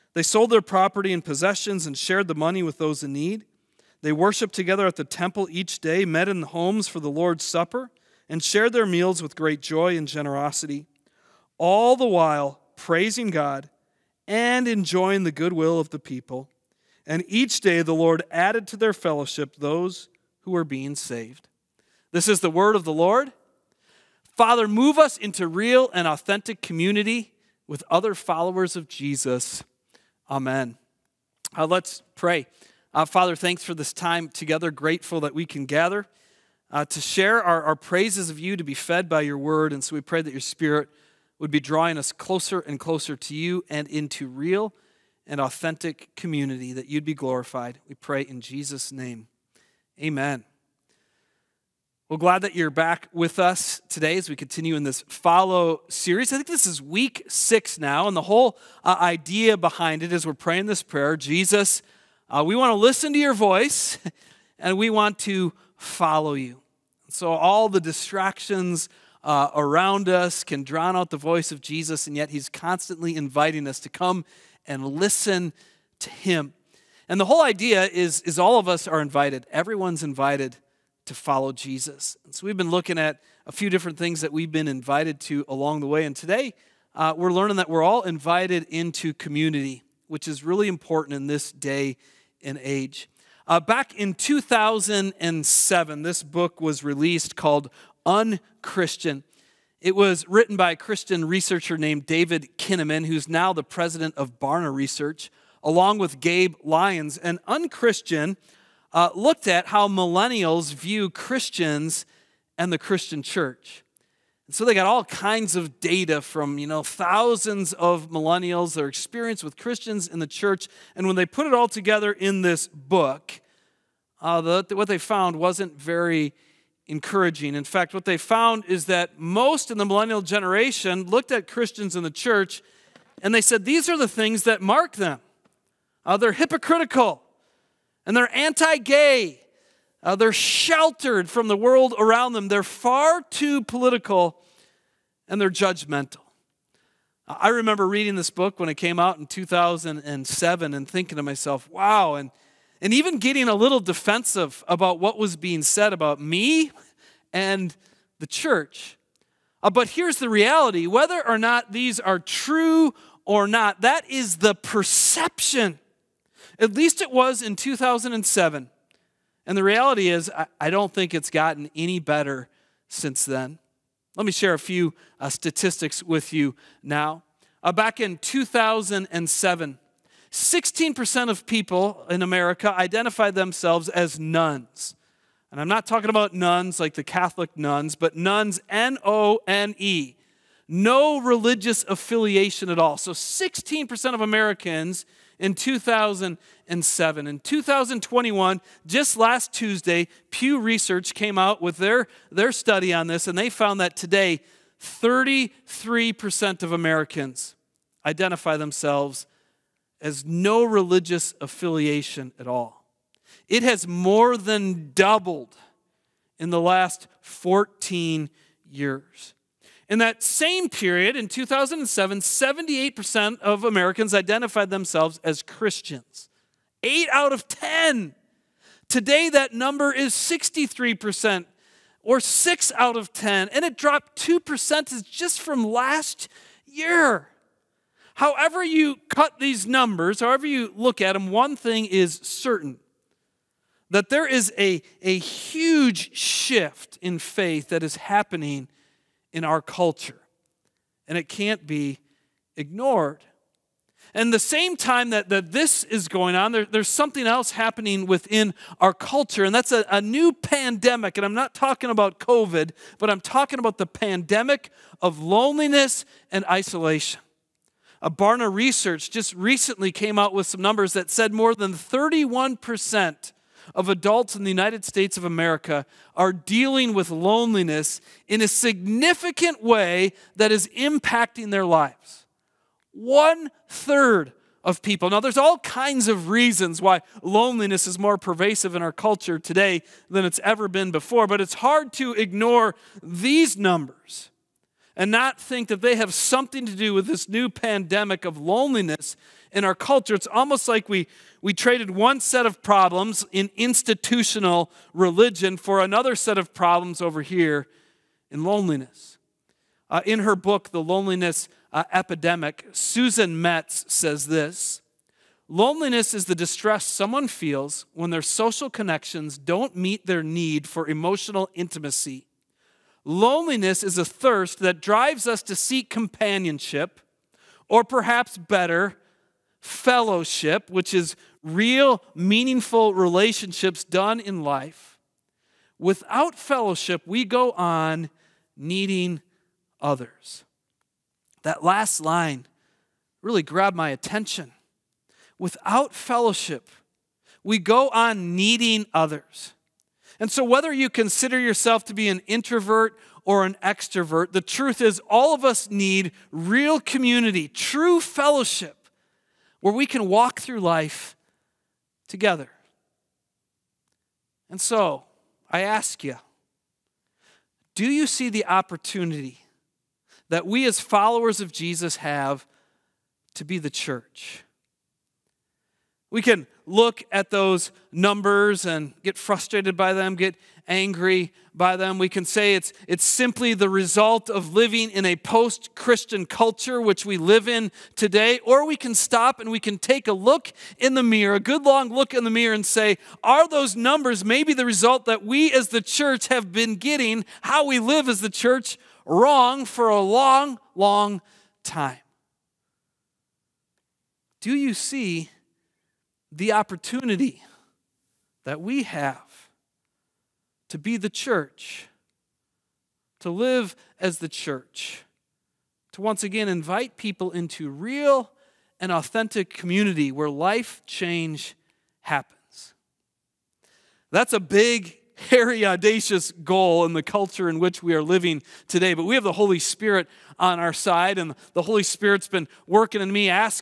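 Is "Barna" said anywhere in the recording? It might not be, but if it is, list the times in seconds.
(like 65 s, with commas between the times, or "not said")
104 s, 268 s.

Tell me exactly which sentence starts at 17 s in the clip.
And each day the Lord added to their fellowship those who were being saved.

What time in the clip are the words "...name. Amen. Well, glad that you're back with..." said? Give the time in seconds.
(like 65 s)
48 s.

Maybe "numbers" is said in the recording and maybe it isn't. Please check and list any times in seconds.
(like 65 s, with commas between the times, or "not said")
229 s, 239 s, 270 s, 293 s, 377 s, 393 s.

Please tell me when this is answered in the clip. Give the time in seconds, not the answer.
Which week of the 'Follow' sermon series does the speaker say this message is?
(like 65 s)
56 s.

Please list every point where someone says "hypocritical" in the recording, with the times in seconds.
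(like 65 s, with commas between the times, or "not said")
136 s.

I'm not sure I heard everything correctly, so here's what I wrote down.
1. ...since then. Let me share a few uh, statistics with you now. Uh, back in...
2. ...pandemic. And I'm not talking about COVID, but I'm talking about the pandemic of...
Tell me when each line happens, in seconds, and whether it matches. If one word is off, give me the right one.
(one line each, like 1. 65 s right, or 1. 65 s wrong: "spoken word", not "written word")
1. 172 s right
2. 260 s right.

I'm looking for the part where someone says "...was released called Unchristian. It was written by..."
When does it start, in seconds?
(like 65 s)
96 s.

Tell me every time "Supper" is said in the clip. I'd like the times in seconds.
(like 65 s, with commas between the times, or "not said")
7 s.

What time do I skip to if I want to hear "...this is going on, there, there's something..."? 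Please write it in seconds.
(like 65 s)
255 s.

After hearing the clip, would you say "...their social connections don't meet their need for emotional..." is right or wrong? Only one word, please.
right.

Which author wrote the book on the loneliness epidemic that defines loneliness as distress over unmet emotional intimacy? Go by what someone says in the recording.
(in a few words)
Susan Mettes.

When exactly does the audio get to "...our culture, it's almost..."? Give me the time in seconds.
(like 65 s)
299 s.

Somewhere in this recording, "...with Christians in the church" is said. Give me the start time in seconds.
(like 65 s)
119 s.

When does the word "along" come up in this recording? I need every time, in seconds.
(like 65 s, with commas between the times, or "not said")
85 s, 105 s.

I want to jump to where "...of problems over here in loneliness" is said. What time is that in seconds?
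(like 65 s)
306 s.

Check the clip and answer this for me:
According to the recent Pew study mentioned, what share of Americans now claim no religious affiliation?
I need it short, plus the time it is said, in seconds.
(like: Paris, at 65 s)
33%, at 204 s.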